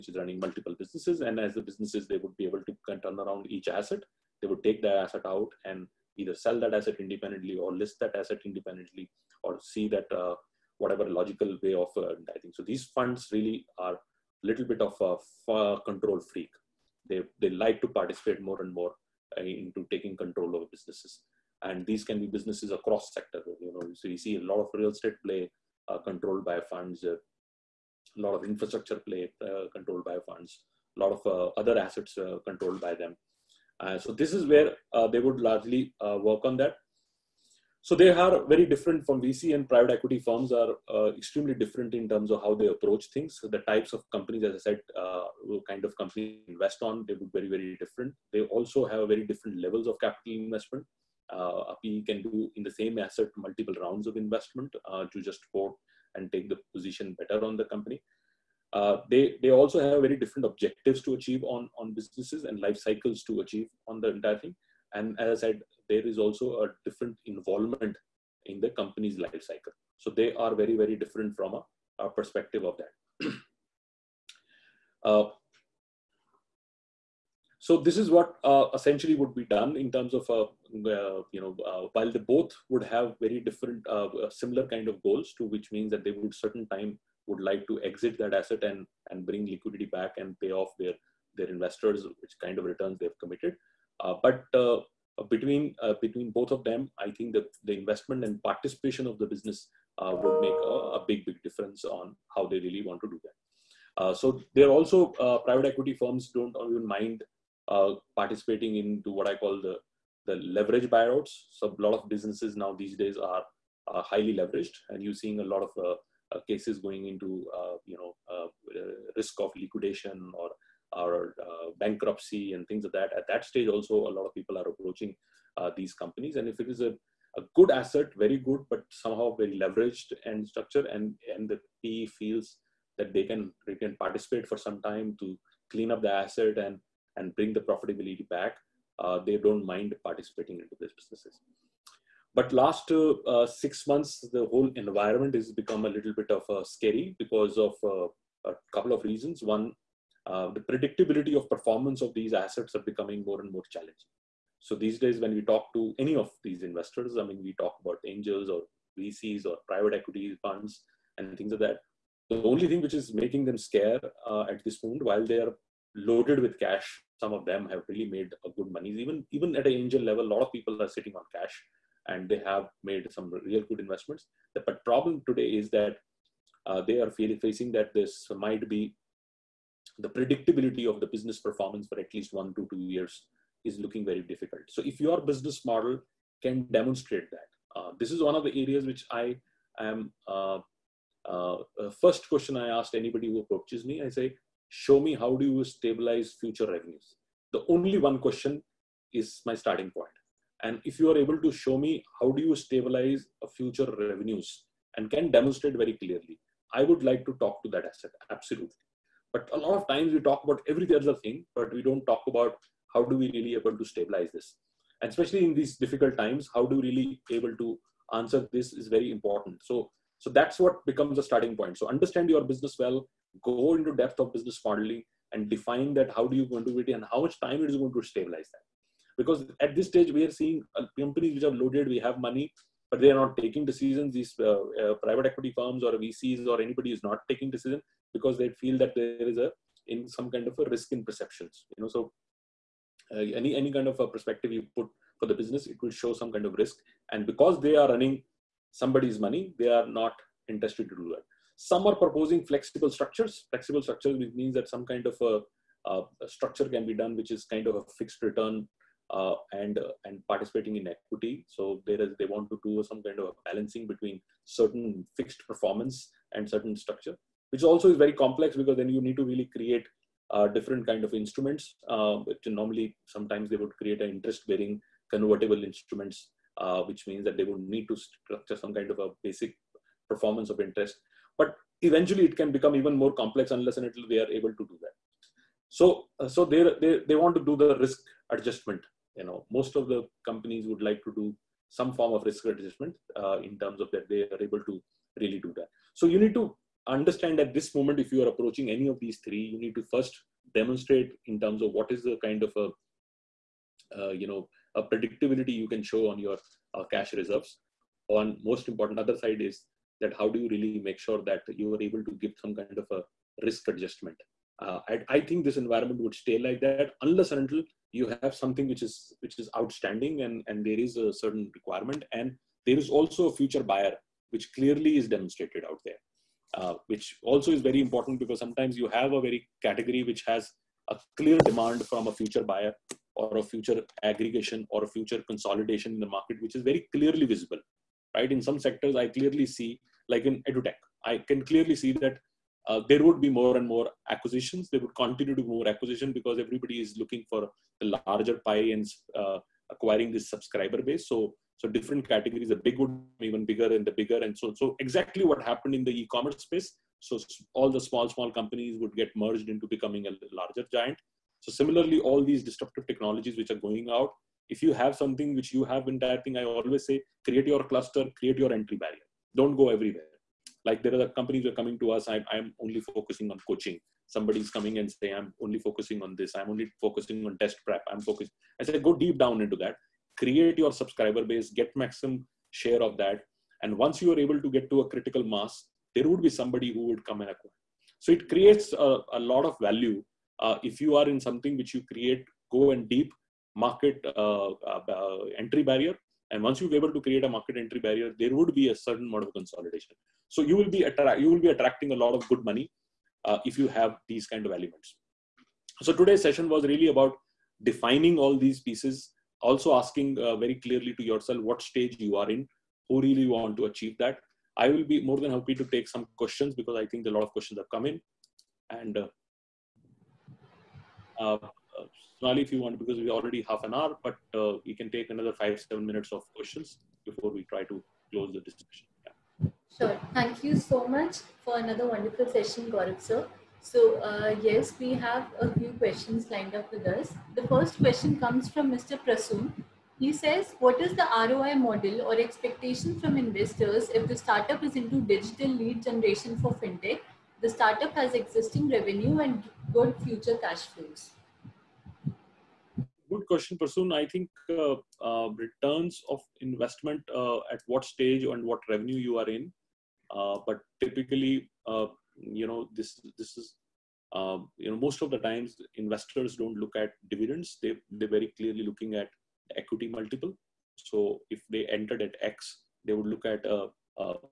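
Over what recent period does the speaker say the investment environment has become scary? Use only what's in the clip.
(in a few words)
six months.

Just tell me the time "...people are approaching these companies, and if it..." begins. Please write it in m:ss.
2:04.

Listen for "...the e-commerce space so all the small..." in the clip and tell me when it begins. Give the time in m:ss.
5:55.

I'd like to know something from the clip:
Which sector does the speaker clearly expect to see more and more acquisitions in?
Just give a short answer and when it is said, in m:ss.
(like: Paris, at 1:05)
edutech, at 5:40.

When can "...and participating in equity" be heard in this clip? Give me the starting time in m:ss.
4:20.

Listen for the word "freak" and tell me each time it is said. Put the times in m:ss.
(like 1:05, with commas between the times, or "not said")
0:16.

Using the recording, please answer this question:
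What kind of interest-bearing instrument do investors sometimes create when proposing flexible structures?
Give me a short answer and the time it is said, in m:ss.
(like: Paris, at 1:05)
convertible instruments, at 4:35.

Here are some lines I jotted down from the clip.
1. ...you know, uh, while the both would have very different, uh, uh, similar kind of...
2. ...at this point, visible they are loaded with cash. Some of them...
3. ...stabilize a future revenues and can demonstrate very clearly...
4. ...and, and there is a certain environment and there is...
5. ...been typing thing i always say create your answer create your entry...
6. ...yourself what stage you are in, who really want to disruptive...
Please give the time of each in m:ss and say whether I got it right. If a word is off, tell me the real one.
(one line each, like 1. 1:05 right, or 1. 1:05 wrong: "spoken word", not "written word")
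1. 1:21 right
2. 2:44 wrong: "while", not "visible"
3. 3:22 right
4. 5:20 wrong: "requirement", not "environment"
5. 6:05 wrong: "cluster", not "answer"
6. 6:51 wrong: "achieve", not "disruptive".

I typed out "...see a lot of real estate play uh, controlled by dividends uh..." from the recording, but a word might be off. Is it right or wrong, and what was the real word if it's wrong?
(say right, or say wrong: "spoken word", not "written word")
wrong: "funds", not "dividends".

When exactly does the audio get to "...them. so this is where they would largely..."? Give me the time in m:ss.
0:33.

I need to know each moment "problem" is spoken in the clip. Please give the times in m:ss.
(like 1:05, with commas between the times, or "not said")
2:54.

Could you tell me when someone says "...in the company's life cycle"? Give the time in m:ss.
1:08.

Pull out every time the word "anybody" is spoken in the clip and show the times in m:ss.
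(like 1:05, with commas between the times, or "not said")
3:12, 3:56.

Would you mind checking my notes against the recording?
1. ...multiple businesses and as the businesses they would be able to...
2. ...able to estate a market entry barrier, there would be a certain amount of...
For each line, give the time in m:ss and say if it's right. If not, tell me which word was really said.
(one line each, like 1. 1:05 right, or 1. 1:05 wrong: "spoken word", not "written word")
1. 0:00 right
2. 6:36 wrong: "create", not "estate".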